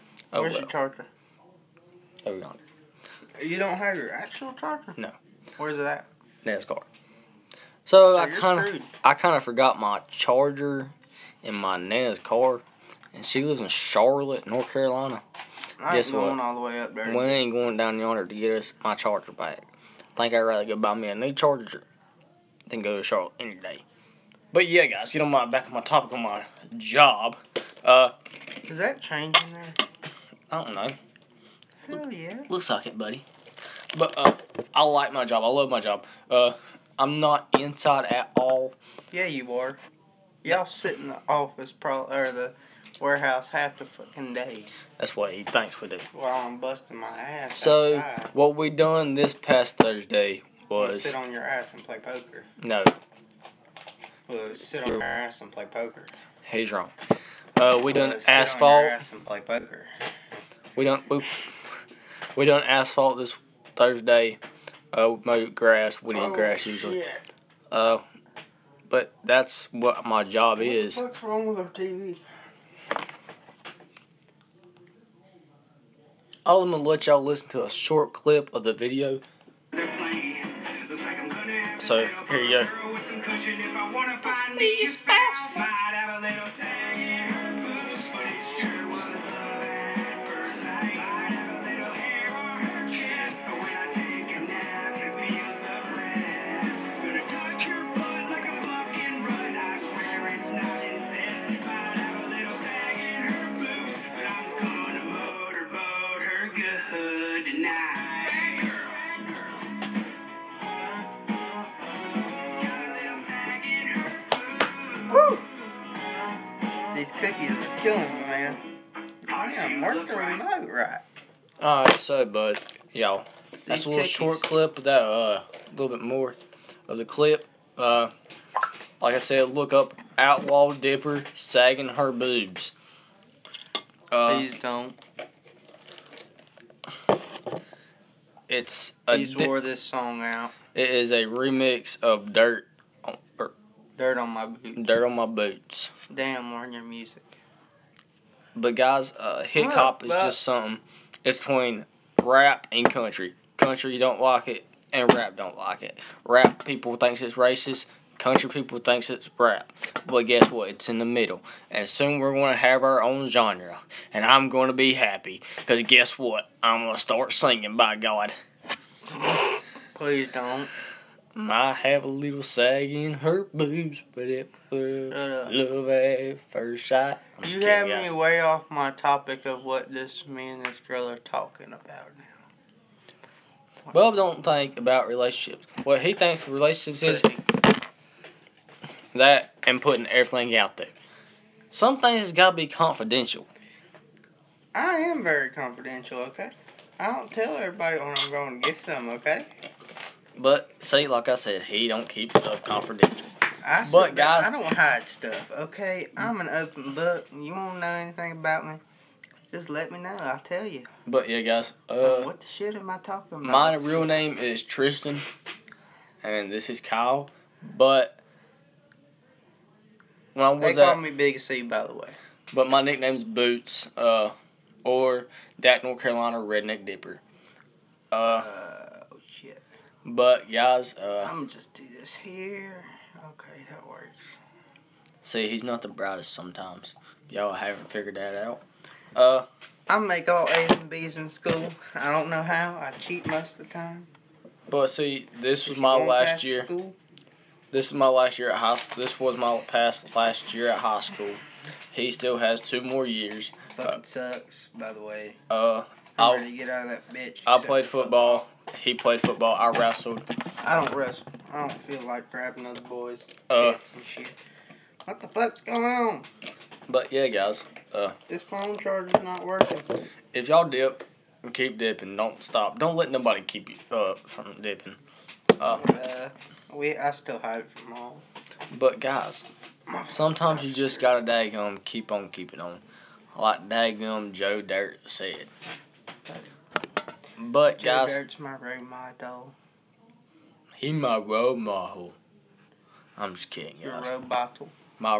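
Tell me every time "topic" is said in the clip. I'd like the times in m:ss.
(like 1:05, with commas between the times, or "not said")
0:25, 2:58.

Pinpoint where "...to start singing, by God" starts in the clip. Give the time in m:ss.
2:46.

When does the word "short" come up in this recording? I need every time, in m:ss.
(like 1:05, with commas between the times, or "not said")
1:17, 2:04.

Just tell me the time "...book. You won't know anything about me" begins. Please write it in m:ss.
3:26.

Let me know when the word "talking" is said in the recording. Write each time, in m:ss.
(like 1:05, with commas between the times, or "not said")
3:01, 3:32.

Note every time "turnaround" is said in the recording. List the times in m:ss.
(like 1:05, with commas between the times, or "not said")
not said.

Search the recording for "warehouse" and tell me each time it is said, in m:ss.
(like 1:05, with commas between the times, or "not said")
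0:42.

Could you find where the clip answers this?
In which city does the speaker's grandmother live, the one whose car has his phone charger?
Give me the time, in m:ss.
0:13.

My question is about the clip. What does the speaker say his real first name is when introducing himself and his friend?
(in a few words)
Tristan.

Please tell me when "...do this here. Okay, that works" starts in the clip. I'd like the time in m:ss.
3:51.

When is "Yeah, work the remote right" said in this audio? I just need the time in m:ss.
1:59.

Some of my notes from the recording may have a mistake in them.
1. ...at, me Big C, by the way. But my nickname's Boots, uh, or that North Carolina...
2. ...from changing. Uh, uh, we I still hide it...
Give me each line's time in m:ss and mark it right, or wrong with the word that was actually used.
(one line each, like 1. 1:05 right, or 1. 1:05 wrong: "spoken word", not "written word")
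1. 3:40 right
2. 4:34 wrong: "dipping", not "changing".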